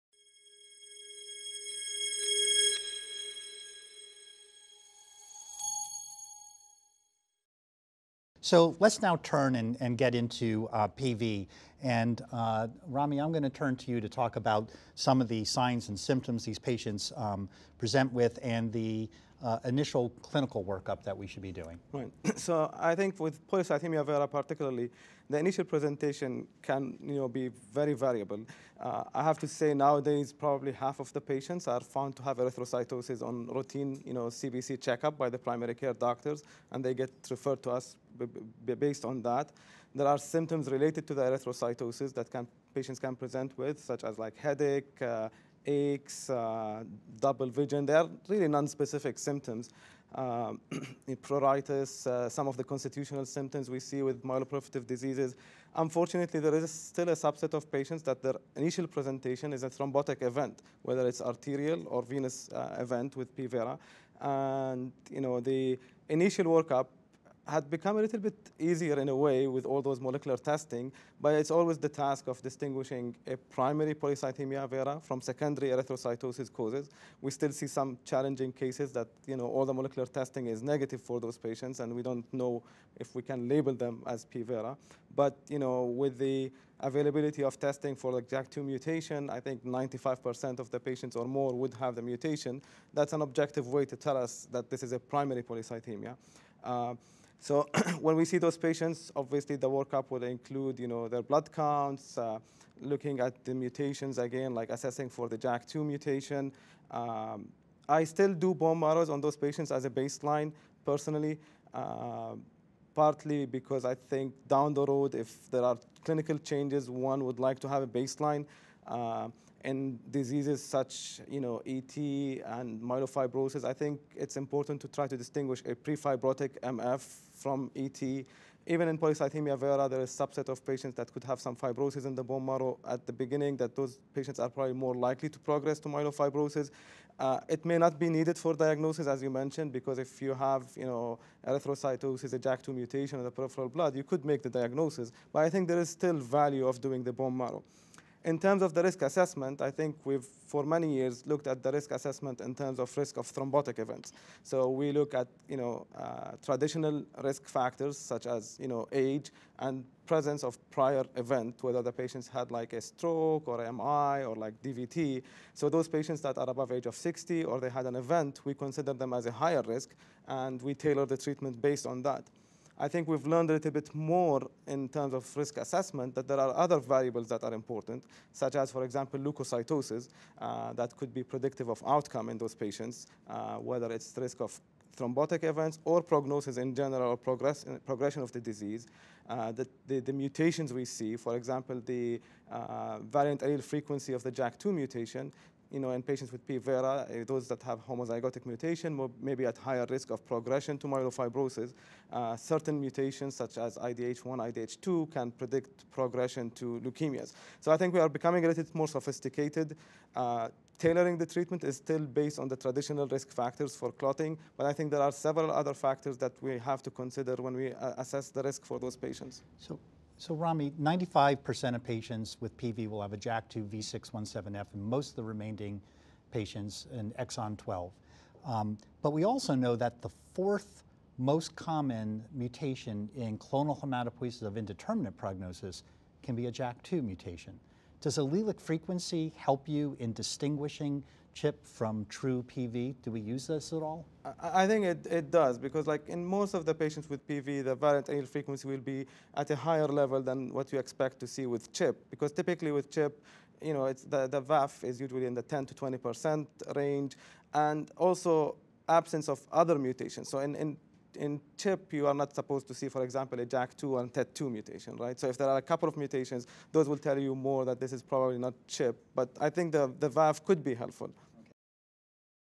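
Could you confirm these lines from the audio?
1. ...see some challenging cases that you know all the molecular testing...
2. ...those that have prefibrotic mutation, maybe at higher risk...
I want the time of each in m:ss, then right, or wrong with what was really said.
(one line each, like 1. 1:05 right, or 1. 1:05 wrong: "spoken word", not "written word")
1. 1:17 right
2. 3:17 wrong: "homozygotic", not "prefibrotic".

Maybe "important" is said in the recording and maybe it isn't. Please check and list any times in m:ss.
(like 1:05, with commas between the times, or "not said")
2:04, 2:57.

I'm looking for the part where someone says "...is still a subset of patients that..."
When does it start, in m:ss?
0:56.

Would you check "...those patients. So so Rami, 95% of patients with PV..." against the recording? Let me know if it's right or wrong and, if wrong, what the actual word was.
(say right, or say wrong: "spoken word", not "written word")
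right.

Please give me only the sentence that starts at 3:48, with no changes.
Um, but we also know that the fourth most common mutation in clonal hematopoiesis of indeterminate prognosis can be a JAK2 mutation.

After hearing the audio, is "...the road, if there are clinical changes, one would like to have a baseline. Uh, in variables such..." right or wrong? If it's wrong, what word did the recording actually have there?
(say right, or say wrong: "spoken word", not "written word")
wrong: "diseases", not "variables".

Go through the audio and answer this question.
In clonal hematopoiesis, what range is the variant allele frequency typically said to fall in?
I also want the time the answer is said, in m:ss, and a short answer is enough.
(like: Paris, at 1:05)
10 to 20%, at 4:15.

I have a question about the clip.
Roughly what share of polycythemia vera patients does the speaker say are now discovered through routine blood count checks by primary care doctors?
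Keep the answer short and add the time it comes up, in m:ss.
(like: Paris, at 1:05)
half, at 0:30.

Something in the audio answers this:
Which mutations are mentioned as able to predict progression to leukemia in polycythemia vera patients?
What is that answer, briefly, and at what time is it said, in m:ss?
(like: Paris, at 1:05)
IDH1, IDH2, at 3:23.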